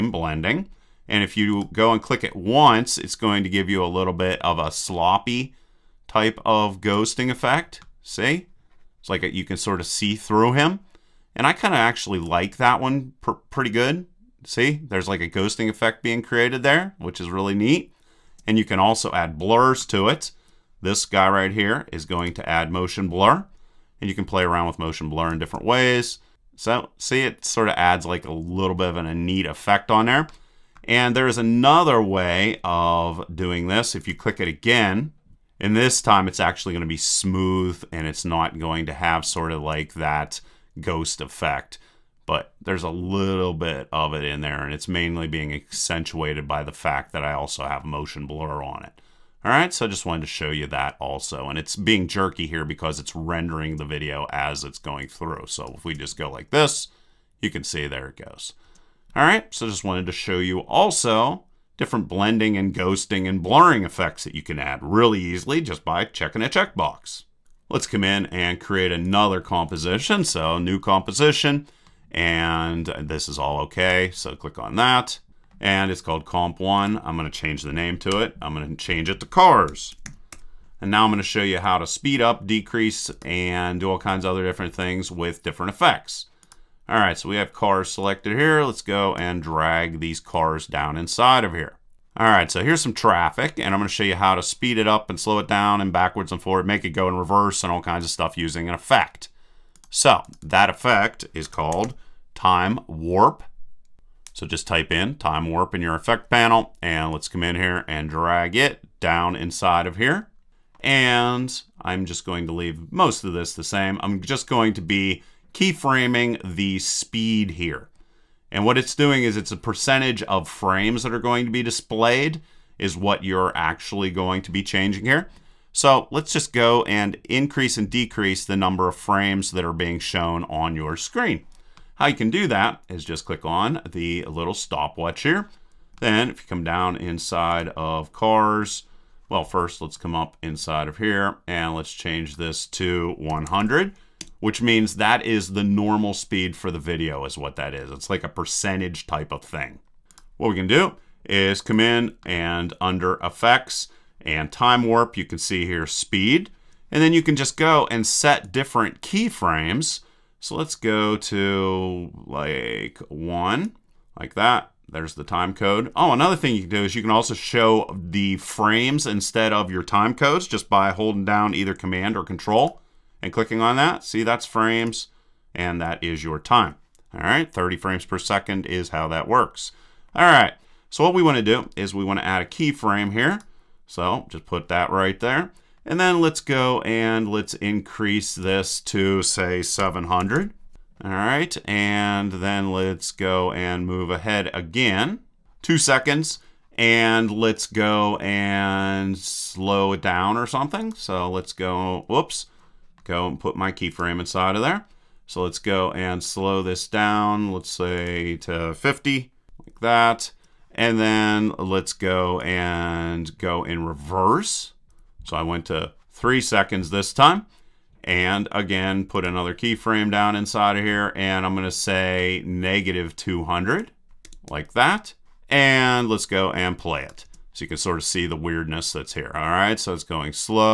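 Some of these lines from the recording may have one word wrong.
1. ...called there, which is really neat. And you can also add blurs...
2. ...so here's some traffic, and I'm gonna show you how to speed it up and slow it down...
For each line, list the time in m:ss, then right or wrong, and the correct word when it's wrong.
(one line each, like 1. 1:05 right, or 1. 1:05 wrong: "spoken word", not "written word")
1. 0:16 wrong: "created", not "called"
2. 1:32 right.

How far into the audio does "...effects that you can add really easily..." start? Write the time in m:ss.
1:03.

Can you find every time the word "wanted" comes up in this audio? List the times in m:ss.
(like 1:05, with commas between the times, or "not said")
0:50, 0:59.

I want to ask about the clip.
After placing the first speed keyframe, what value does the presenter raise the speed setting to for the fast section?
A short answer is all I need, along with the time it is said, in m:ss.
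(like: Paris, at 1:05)
700, at 3:09.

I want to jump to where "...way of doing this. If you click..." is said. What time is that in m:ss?
0:32.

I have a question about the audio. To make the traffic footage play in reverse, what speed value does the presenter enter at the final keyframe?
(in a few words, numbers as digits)
-200.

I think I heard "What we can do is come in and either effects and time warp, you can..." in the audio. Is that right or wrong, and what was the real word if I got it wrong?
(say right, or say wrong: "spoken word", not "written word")
wrong: "under", not "either".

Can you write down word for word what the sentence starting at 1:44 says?
So just type in time warp in your effect panel, and let's come in here and drag it down inside of here.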